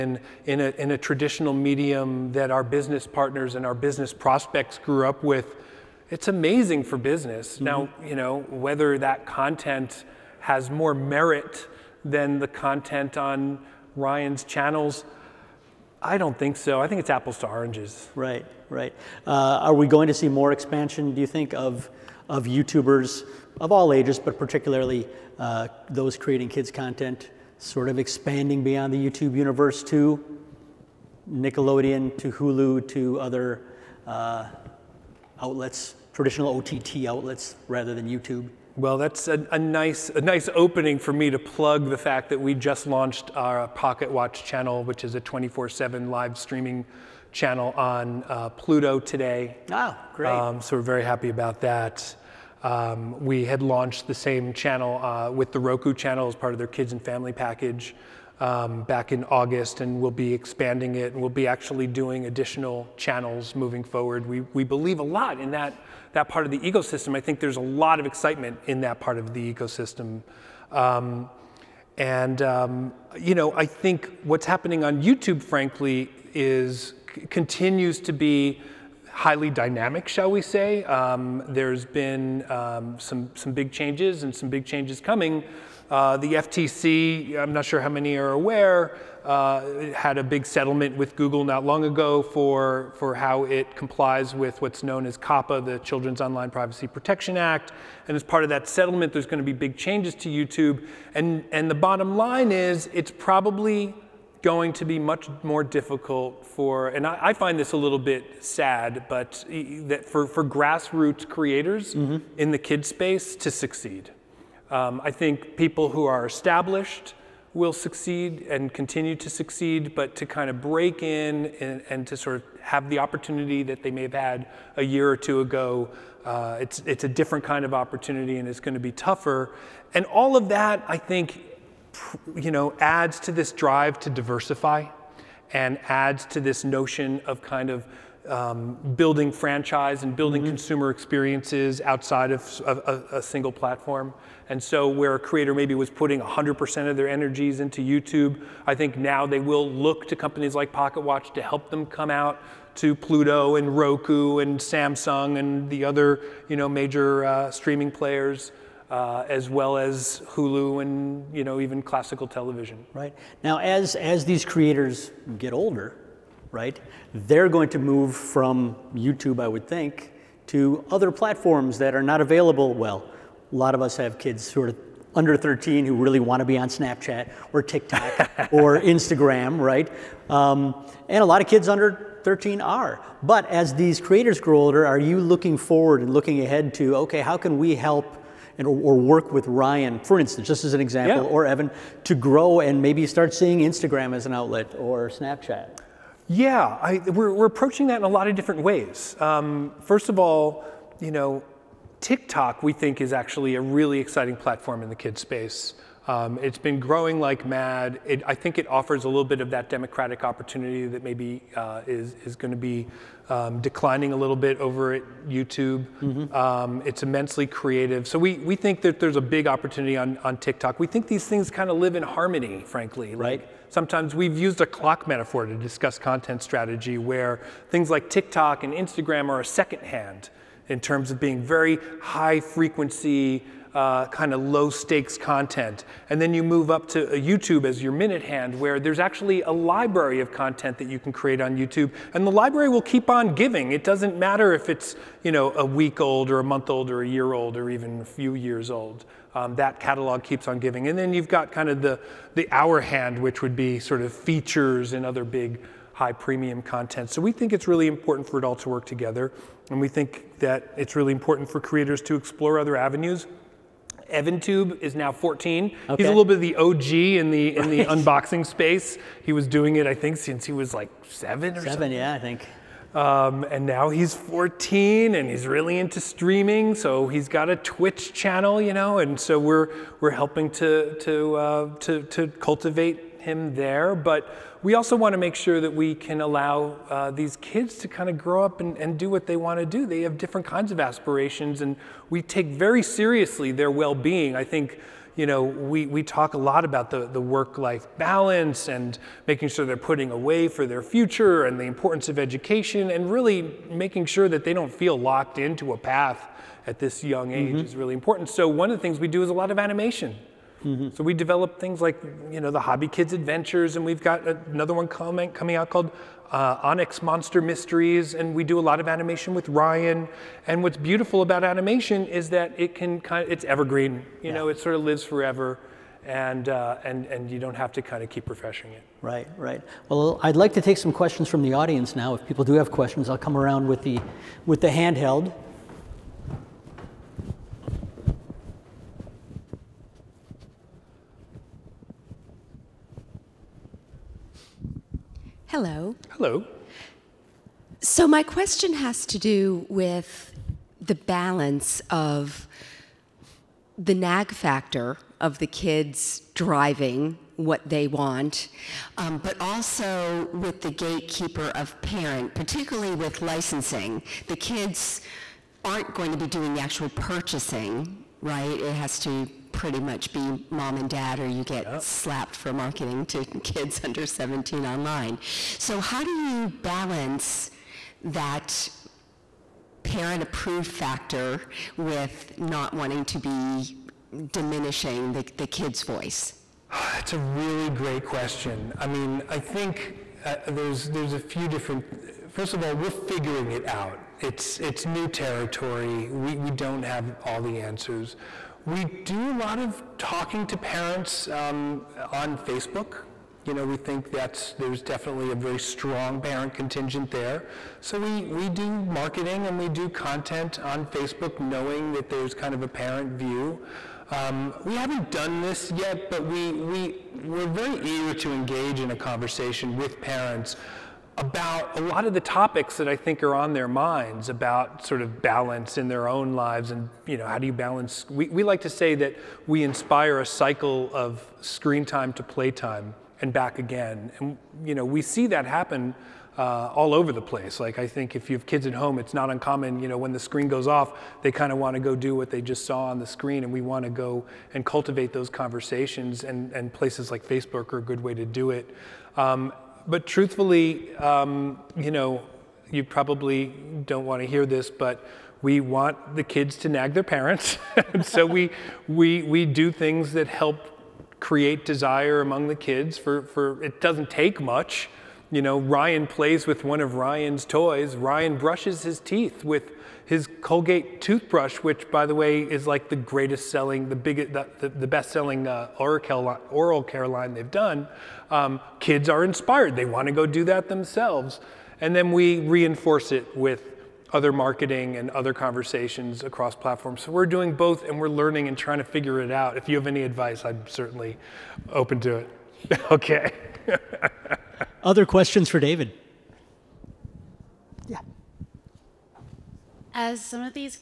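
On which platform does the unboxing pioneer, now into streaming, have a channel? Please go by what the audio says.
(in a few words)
Twitch.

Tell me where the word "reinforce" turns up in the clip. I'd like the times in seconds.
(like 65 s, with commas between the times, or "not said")
482 s.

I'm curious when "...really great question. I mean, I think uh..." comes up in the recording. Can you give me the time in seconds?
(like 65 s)
387 s.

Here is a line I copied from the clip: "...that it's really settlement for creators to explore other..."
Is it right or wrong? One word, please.
wrong.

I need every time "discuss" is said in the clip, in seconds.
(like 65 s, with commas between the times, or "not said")
225 s.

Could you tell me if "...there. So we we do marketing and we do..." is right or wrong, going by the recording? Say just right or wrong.
right.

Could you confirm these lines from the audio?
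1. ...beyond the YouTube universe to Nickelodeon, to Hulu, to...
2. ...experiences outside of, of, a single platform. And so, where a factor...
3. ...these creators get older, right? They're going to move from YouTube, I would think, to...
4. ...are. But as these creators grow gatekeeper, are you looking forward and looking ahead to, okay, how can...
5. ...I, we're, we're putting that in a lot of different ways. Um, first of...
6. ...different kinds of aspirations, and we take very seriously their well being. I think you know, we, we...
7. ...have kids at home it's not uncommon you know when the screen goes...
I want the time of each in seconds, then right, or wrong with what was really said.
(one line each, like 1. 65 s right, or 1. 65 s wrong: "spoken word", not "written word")
1. 28 s right
2. 140 s wrong: "creator", not "factor"
3. 164 s right
4. 182 s wrong: "older", not "gatekeeper"
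5. 196 s wrong: "approaching", not "putting"
6. 290 s right
7. 438 s right.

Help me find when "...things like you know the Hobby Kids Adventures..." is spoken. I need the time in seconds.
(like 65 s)
311 s.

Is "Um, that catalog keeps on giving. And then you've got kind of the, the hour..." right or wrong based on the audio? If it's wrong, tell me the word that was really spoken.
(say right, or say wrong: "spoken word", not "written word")
right.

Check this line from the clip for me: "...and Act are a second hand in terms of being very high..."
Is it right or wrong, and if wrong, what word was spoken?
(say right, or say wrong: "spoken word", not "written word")
wrong: "Instagram", not "Act".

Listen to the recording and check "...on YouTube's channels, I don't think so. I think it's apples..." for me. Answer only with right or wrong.
wrong.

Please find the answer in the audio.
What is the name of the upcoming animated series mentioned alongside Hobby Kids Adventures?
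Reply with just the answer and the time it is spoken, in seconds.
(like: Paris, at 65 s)
Onyx Monster Mysteries, at 316 s.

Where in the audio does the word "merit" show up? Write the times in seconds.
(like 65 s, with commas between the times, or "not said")
10 s.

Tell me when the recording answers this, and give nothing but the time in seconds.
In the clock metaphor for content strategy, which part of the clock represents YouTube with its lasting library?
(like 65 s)
237 s.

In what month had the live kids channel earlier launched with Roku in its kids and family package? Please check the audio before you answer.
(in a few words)
August.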